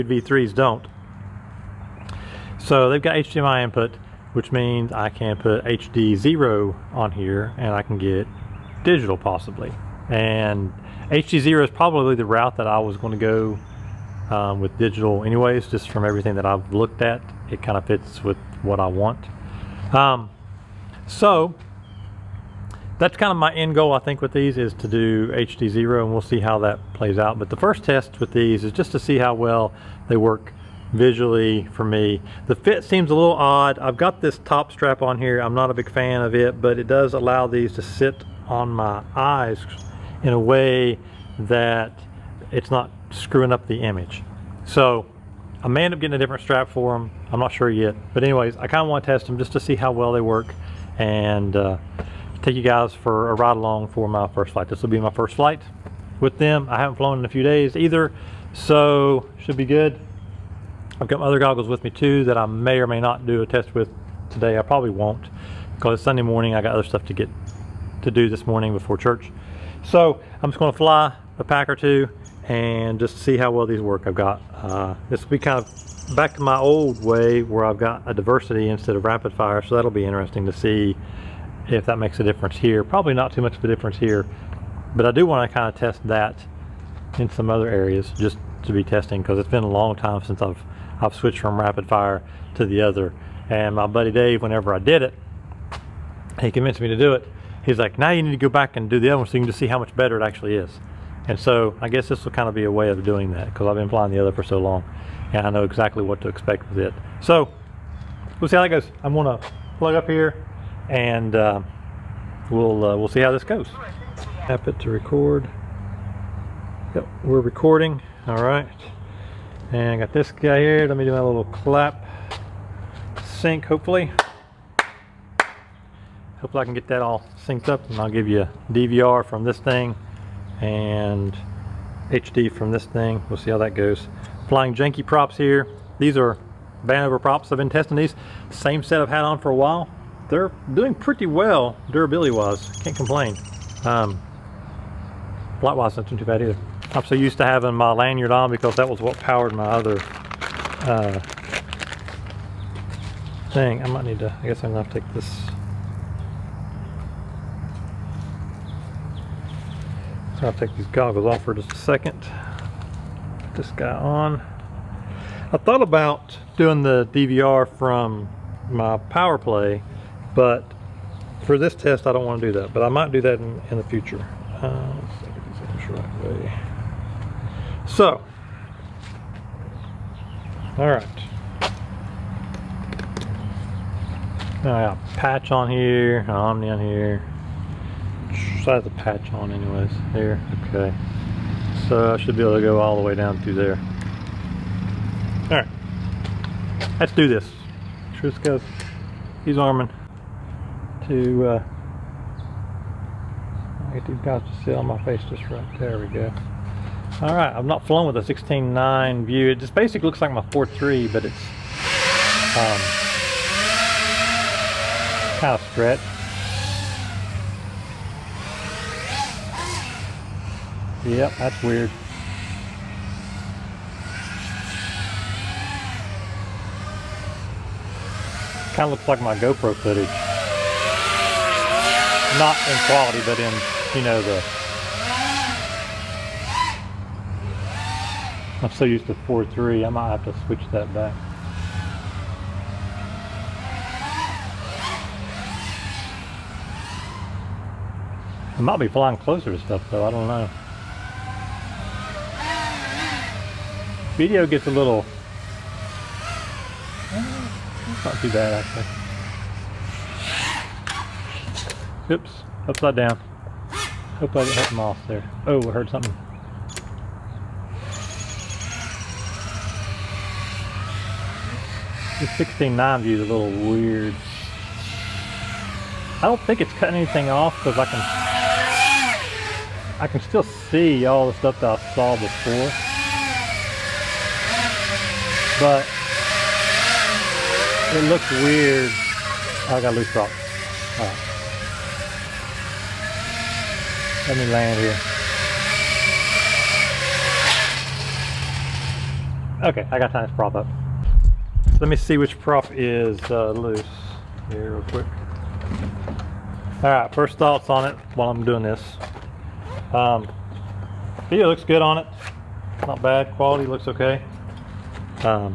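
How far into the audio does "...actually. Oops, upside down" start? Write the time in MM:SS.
04:20.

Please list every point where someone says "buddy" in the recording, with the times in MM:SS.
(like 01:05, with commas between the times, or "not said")
01:33.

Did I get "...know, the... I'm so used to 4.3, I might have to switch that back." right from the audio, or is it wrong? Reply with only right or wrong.
right.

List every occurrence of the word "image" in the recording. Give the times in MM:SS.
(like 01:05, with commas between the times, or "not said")
00:43.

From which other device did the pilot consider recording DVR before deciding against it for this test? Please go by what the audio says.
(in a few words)
Power Play.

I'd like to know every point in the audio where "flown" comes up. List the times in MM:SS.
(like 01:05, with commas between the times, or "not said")
00:56, 03:27.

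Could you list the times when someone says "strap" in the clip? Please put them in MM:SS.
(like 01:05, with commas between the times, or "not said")
00:34, 00:46.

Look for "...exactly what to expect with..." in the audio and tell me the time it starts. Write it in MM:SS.
01:45.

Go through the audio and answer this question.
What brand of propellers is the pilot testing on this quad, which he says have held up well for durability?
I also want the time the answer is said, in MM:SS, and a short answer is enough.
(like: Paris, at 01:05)
Vanover, at 02:16.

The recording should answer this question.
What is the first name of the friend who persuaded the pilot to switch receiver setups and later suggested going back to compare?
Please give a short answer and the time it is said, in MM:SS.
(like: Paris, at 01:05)
Dave, at 01:34.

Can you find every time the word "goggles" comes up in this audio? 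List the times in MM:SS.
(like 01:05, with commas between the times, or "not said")
01:01, 02:40.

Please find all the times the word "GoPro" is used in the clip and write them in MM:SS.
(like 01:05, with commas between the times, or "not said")
03:49.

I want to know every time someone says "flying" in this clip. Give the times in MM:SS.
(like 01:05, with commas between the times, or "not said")
01:43, 02:14, 04:08.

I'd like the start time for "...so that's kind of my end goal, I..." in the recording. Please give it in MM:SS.
00:21.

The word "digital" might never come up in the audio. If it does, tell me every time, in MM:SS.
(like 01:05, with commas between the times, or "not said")
00:08, 00:14.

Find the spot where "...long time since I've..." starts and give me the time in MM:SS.
01:29.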